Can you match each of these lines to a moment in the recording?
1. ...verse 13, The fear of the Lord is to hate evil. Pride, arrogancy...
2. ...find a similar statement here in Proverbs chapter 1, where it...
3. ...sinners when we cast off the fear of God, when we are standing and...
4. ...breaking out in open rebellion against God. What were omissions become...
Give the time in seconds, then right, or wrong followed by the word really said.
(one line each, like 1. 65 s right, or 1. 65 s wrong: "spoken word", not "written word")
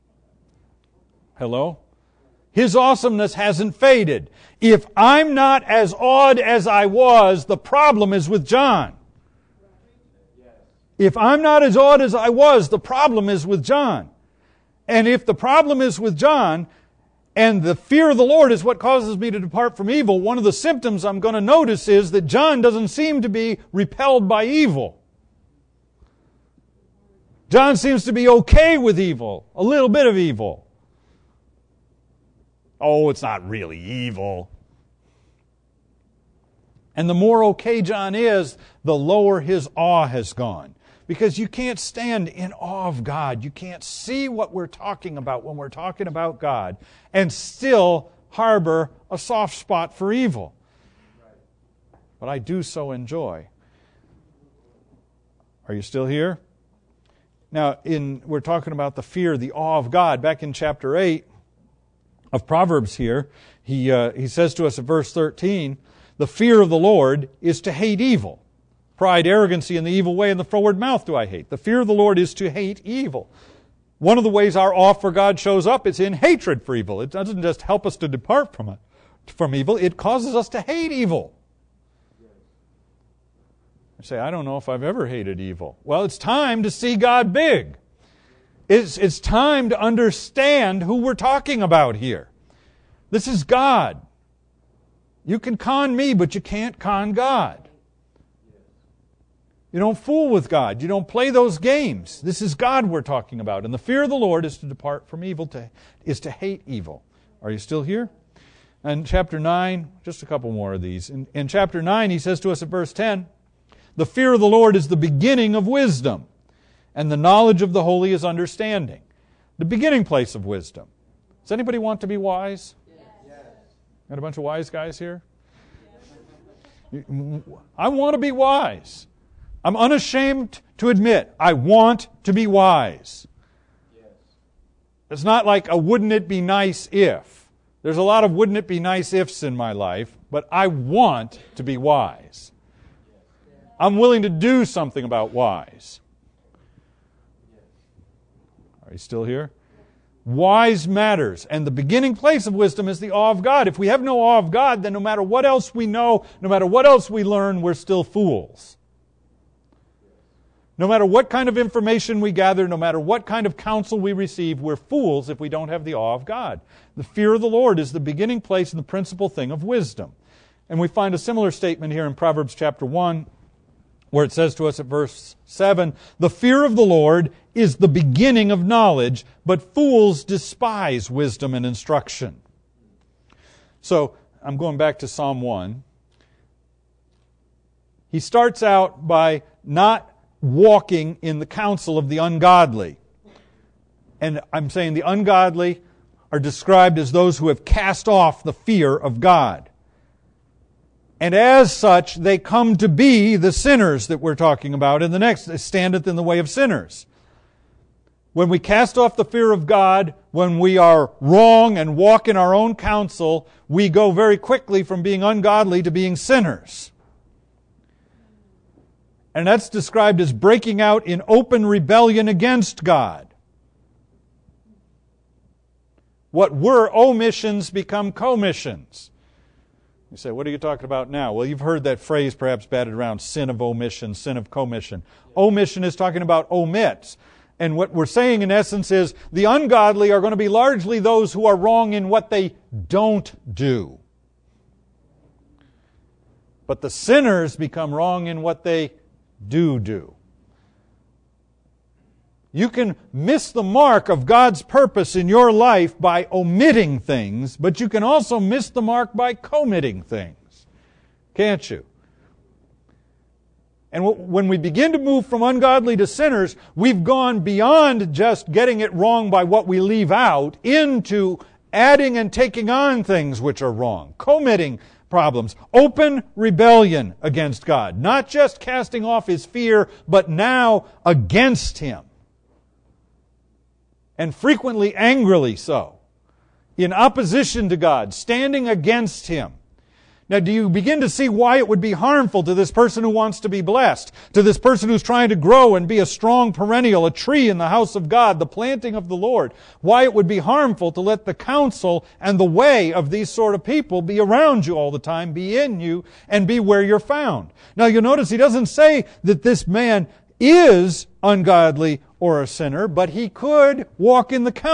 1. 64 s right
2. 170 s right
3. 206 s wrong: "wrong", not "standing"
4. 220 s right.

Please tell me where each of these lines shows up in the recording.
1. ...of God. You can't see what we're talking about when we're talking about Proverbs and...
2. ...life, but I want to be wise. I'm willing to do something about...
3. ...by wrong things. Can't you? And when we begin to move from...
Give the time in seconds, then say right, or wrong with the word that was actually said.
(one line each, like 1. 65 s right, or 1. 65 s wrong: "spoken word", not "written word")
1. 42 s wrong: "God", not "Proverbs"
2. 139 s right
3. 259 s wrong: "committing", not "wrong".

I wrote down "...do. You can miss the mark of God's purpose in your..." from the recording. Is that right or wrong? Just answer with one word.
right.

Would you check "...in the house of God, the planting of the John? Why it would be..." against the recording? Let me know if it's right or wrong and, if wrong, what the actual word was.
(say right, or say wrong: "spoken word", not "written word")
wrong: "Lord", not "John".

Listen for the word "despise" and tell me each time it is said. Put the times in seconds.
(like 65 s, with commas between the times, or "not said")
180 s.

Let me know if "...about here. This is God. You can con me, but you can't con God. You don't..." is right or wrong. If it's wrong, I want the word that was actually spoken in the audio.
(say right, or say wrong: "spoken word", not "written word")
right.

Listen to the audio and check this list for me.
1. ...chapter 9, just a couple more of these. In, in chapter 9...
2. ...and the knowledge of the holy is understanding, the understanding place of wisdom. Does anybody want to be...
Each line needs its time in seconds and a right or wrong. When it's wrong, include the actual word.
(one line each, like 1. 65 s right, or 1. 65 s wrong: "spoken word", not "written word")
1. 109 s right
2. 116 s wrong: "beginning", not "understanding".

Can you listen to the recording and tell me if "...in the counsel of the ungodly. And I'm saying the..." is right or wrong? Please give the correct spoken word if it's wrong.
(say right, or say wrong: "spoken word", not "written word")
right.